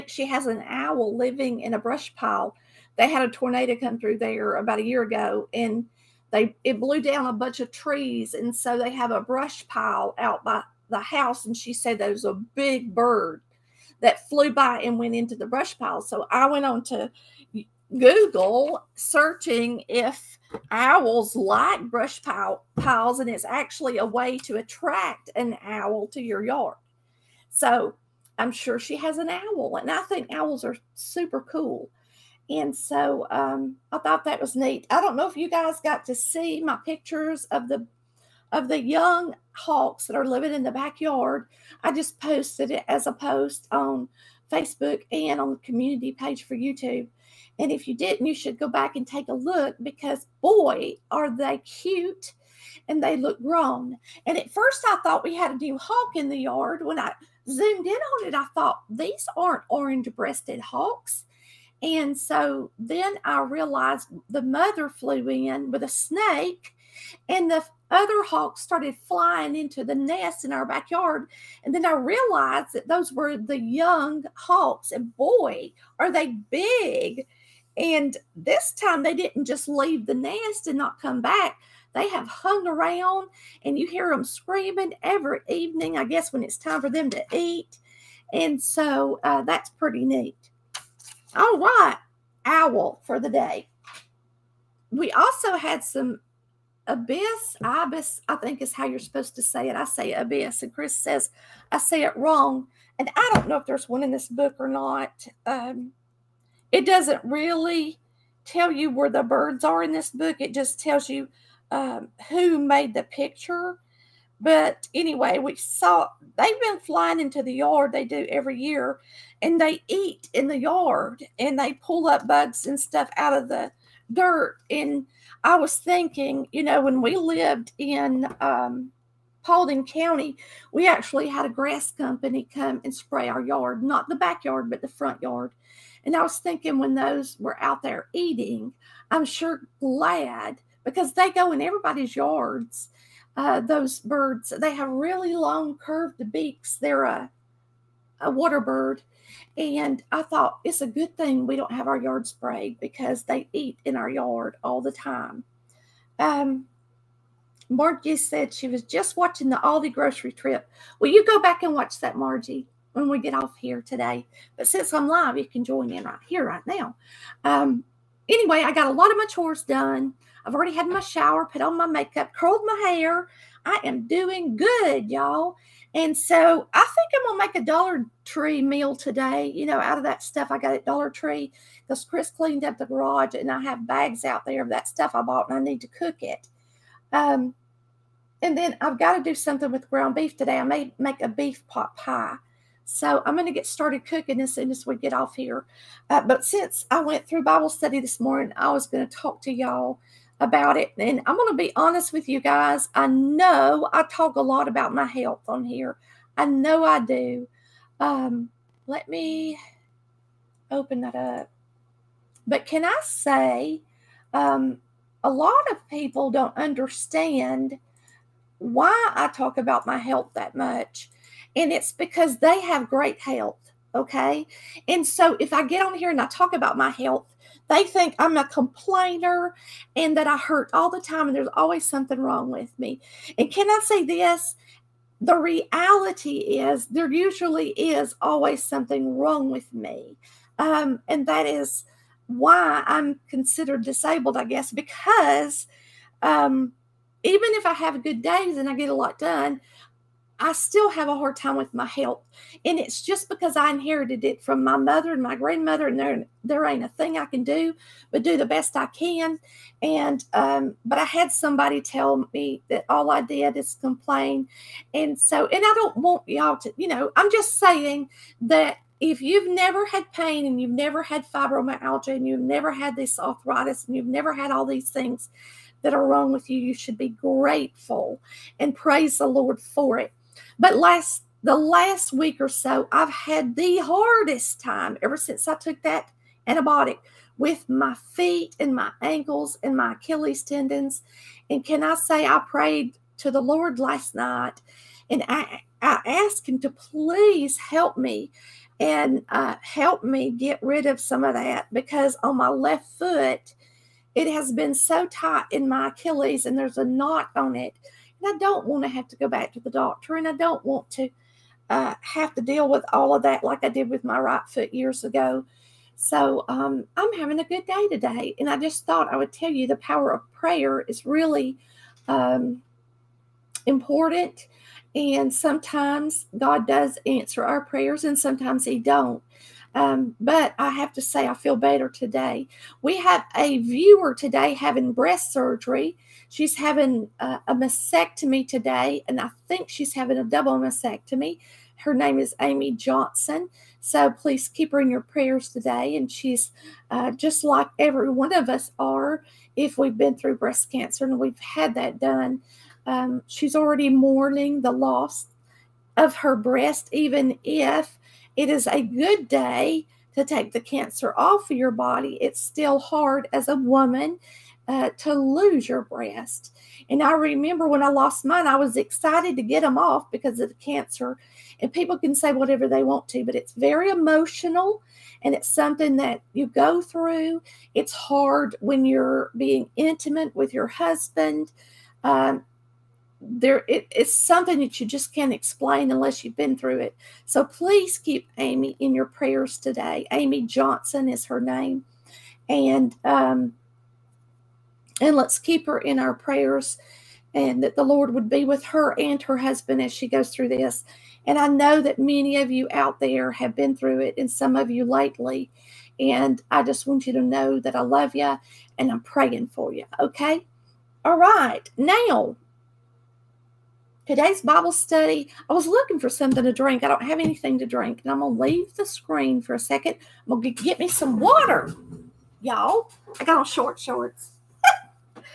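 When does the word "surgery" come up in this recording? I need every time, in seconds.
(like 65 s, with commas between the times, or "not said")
335 s.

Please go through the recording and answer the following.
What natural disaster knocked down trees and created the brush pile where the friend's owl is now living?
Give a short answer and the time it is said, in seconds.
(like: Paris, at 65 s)
Tornado, at 3 s.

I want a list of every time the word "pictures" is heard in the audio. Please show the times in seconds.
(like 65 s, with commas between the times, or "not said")
36 s, 113 s.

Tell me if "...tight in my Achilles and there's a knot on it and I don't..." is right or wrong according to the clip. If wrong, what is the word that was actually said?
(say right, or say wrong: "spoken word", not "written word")
right.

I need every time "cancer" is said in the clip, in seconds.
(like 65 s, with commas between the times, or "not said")
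350 s, 360 s, 370 s.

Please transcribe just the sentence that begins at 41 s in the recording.
I just posted it as a post on Facebook and on the community page for YouTube.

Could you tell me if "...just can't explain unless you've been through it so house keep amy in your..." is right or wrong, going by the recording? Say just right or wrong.
wrong.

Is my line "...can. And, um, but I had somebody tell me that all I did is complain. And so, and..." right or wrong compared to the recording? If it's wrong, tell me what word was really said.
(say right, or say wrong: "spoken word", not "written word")
right.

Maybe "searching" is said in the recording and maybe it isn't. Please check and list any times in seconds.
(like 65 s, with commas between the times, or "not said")
18 s.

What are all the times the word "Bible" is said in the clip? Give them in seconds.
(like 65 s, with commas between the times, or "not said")
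197 s, 414 s.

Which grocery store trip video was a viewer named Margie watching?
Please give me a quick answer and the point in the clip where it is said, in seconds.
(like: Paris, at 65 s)
Aldi, at 159 s.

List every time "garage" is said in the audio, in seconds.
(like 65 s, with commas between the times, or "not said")
182 s.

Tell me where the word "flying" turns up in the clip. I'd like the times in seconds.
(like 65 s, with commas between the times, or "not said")
69 s, 116 s.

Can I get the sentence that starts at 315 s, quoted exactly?
So um, I'm having a good day today.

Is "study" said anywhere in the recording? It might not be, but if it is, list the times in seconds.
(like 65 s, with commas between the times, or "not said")
197 s, 414 s.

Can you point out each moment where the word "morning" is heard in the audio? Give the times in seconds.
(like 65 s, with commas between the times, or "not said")
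198 s.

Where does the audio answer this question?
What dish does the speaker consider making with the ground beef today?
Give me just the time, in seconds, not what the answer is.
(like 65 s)
191 s.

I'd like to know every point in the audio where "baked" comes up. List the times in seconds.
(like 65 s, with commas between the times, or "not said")
not said.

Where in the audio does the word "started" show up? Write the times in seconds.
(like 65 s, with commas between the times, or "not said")
68 s, 193 s.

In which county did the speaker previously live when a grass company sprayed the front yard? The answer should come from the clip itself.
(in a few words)
Paulding County.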